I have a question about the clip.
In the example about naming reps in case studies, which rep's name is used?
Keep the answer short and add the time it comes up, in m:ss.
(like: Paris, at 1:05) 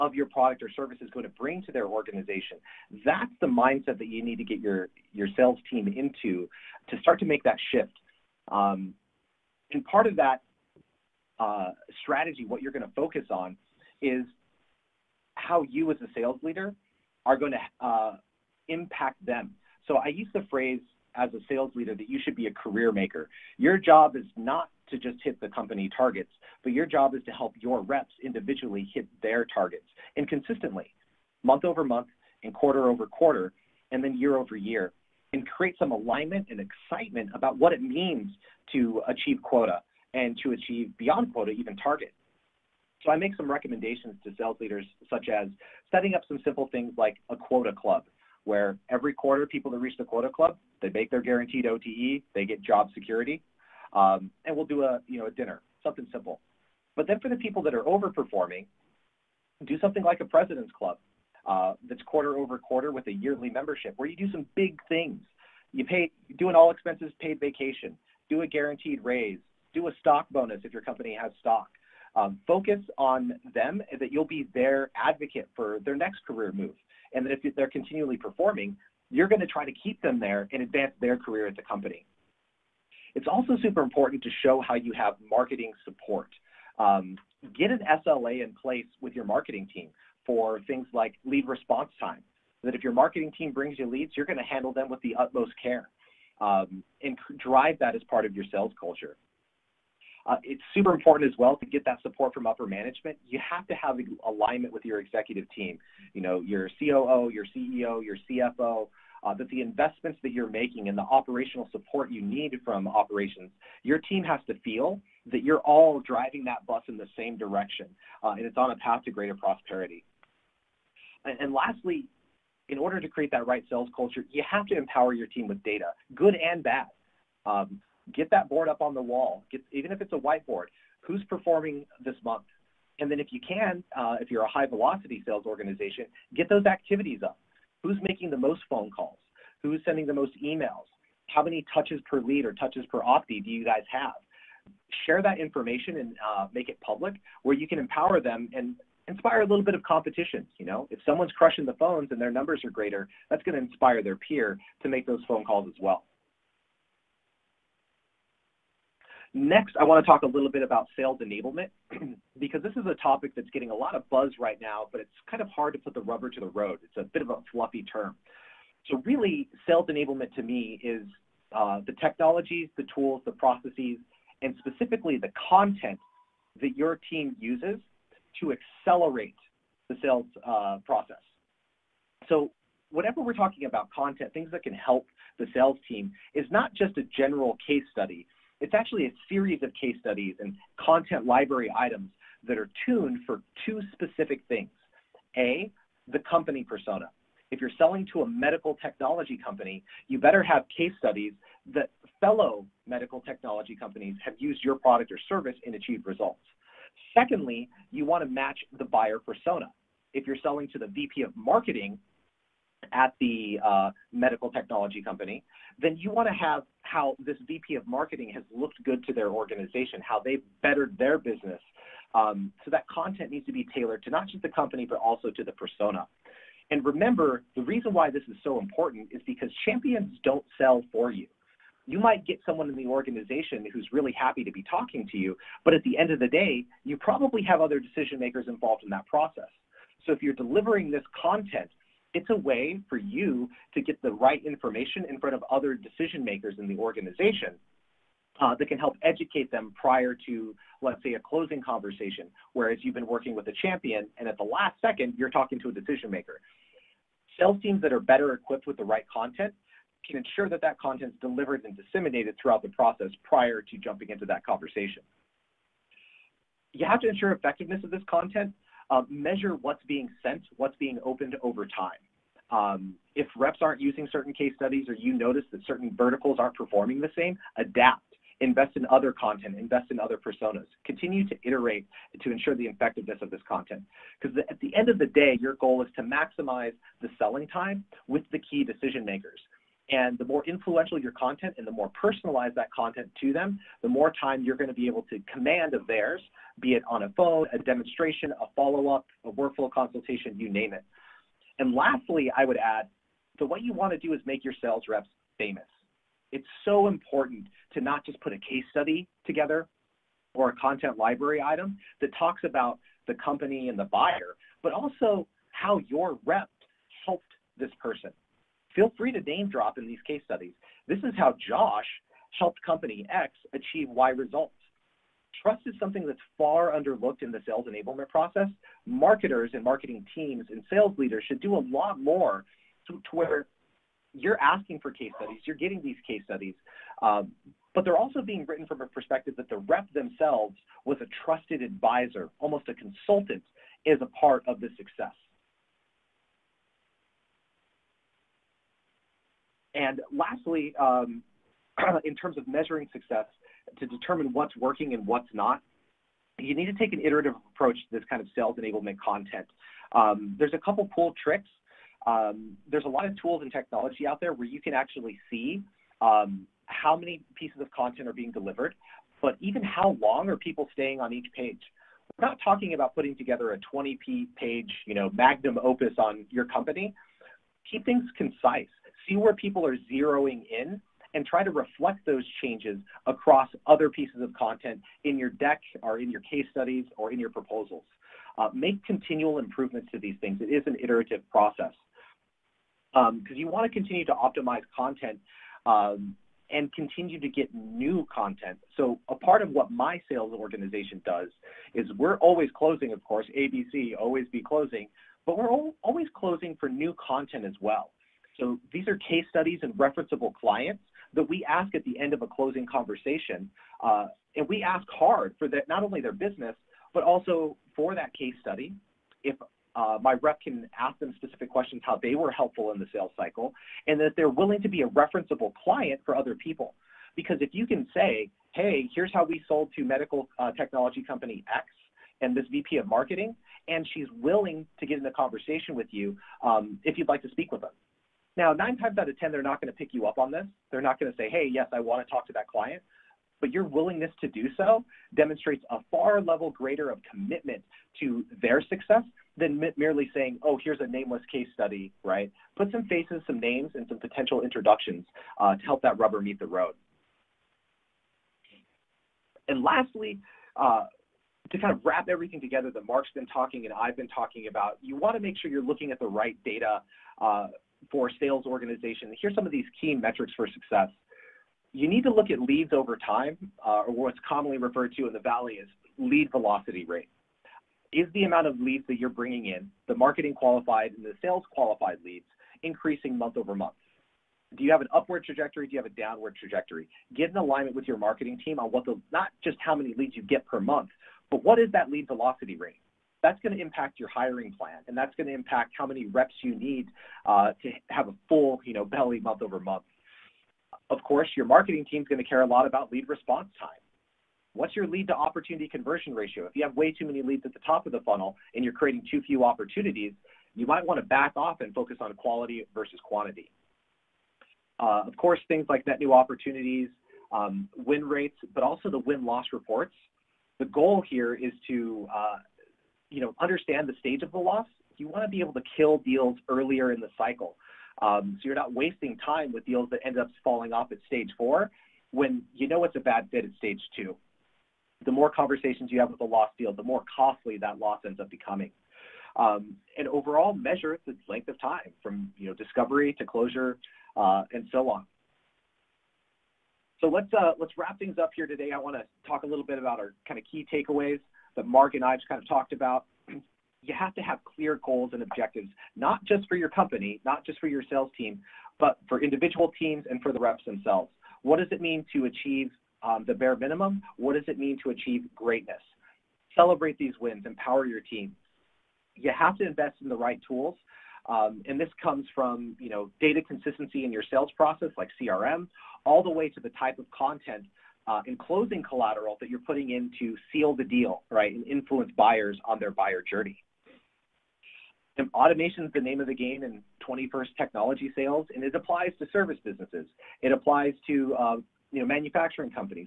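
Josh, at 5:21.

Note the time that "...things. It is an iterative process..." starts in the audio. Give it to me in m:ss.
6:30.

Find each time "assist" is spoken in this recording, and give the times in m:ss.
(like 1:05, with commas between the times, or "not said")
not said.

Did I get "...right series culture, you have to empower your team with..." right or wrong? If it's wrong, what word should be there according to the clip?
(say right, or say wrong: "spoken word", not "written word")
wrong: "sales", not "series".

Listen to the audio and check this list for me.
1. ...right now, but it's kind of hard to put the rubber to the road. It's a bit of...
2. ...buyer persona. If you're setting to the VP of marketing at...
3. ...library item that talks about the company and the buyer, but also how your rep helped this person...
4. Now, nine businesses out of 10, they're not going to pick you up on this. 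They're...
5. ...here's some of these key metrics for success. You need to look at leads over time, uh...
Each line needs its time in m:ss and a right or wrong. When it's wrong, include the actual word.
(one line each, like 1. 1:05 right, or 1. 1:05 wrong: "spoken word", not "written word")
1. 2:44 right
2. 3:28 wrong: "selling", not "setting"
3. 5:10 right
4. 7:18 wrong: "times", not "businesses"
5. 7:49 right.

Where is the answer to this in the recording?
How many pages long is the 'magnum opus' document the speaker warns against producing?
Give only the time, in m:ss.
6:13.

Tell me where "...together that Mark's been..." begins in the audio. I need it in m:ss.
7:42.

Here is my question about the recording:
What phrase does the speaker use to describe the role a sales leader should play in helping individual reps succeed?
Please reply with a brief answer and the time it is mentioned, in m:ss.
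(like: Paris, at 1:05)
career maker, at 0:22.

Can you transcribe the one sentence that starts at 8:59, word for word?
Um, and overall, measure its length of time from you know discovery to closure uh, and so on.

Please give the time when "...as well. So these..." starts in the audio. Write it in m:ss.
6:47.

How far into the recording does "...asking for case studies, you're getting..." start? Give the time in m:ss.
5:34.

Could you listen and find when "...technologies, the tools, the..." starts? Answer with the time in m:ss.
2:51.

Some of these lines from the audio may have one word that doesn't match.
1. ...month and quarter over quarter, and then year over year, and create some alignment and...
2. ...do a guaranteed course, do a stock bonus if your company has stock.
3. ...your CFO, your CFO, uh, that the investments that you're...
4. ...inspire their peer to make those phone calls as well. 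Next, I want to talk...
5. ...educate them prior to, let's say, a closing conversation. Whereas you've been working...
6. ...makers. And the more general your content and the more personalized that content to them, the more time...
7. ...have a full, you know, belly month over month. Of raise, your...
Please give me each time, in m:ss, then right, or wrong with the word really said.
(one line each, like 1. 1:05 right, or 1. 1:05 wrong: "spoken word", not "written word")
1. 0:31 right
2. 1:08 wrong: "raise", not "course"
3. 1:47 wrong: "CEO", not "CFO"
4. 2:33 right
5. 4:09 right
6. 4:49 wrong: "influential", not "general"
7. 8:17 wrong: "course", not "raise".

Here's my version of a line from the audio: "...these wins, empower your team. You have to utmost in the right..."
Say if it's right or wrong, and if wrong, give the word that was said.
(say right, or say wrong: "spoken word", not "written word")
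wrong: "invest", not "utmost".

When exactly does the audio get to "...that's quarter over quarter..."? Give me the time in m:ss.
1:01.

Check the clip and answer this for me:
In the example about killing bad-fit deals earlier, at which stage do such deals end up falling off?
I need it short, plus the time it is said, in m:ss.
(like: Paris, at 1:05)
stage four, at 8:51.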